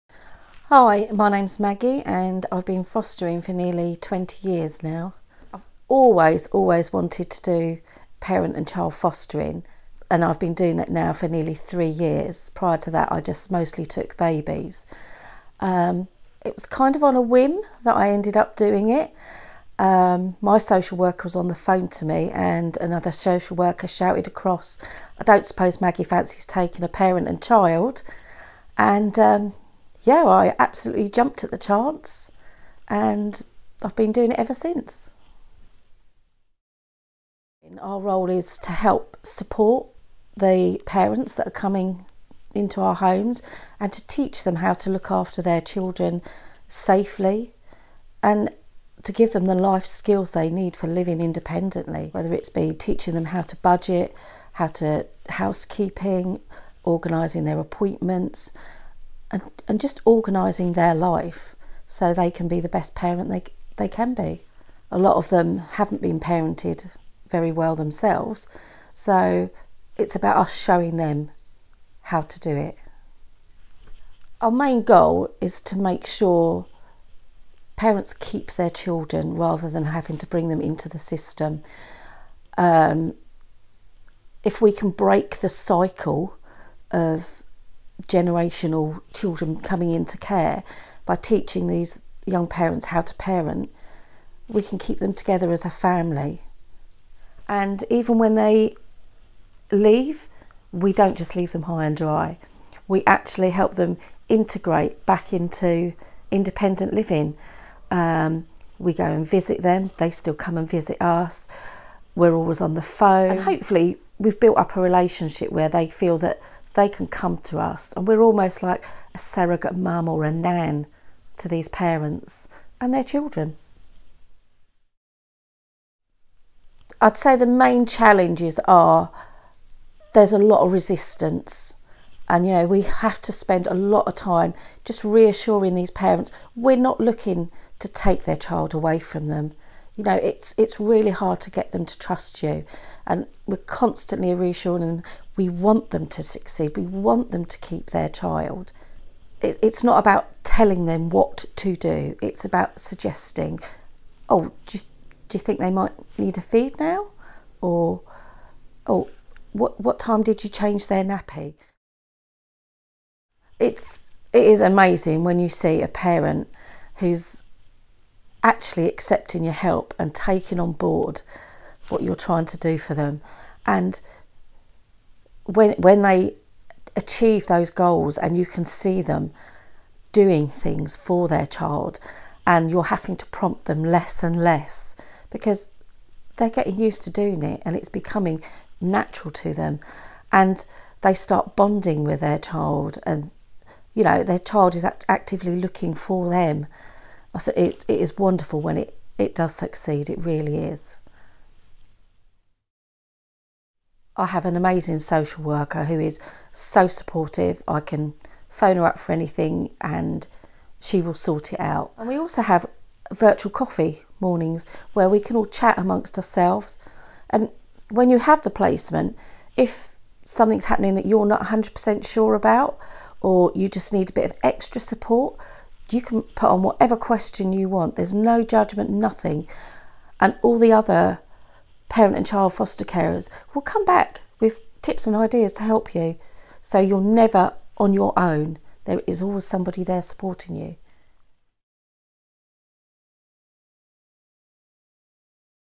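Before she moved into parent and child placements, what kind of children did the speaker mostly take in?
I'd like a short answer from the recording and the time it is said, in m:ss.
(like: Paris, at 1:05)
babies, at 0:14.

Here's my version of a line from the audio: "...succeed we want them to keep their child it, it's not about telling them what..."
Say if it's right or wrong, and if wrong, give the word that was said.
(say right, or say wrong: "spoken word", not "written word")
right.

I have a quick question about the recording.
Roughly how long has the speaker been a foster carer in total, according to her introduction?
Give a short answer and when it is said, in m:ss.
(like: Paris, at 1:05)
nearly 20 years, at 0:03.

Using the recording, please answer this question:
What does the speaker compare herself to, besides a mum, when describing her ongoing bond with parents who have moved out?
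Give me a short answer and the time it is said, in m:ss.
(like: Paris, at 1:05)
a nan, at 2:00.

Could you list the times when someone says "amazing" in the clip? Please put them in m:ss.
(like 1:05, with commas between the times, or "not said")
2:44, 3:24.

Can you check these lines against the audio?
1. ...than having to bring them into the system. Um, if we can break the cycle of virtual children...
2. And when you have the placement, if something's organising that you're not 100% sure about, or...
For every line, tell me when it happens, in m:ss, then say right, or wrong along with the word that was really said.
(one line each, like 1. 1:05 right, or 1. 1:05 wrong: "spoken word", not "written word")
1. 1:19 wrong: "generational", not "virtual"
2. 3:37 wrong: "happening", not "organising".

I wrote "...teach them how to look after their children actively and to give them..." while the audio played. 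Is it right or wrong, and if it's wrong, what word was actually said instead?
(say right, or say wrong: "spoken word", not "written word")
wrong: "safely", not "actively".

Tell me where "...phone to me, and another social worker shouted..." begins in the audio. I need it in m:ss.
0:21.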